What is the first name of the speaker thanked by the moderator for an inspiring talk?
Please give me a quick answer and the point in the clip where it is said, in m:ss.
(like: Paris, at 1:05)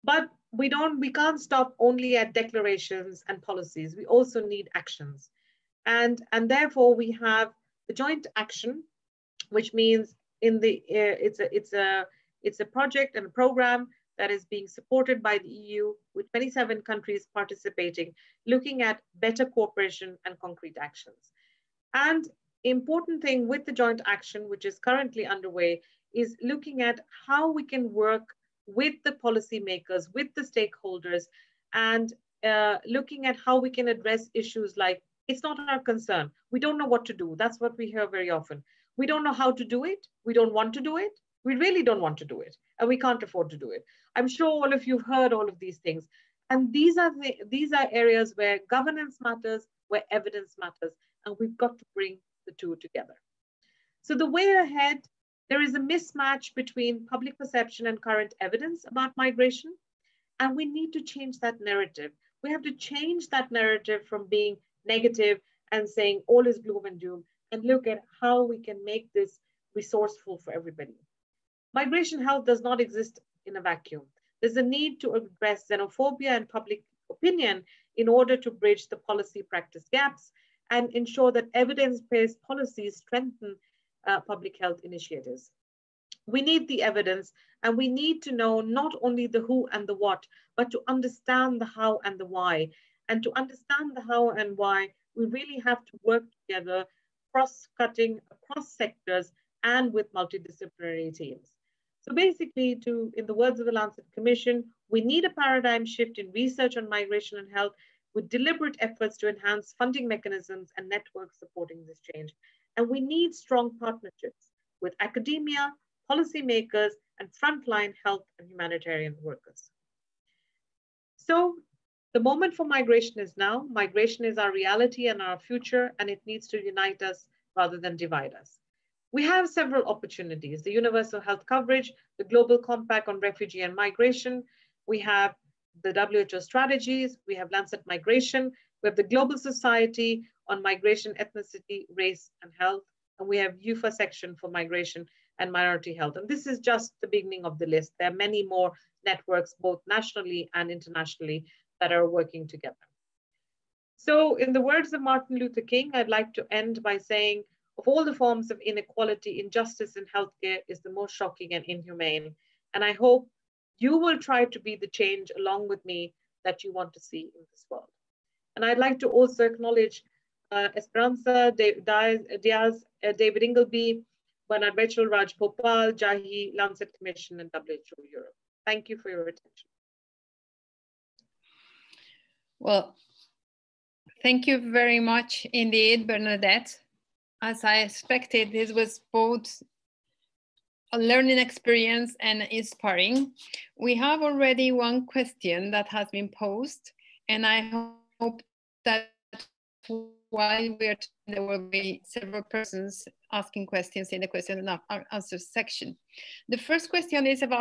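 Bernadette, at 3:06.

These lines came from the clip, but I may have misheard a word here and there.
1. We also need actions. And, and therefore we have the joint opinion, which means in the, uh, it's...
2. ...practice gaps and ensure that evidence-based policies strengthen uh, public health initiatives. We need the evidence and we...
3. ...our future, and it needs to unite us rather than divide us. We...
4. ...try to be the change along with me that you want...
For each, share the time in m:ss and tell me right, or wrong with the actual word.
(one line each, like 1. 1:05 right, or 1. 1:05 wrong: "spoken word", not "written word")
1. 0:03 wrong: "action", not "opinion"
2. 1:19 right
3. 2:05 right
4. 2:44 right.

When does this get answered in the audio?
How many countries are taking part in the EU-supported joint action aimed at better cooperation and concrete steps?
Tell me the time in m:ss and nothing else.
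0:16.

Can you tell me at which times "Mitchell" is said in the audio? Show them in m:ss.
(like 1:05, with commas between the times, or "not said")
2:54.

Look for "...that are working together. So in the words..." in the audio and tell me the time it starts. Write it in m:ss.
2:31.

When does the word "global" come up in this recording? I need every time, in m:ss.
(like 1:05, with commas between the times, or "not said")
2:12, 2:19.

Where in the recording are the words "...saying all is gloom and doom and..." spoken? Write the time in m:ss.
1:05.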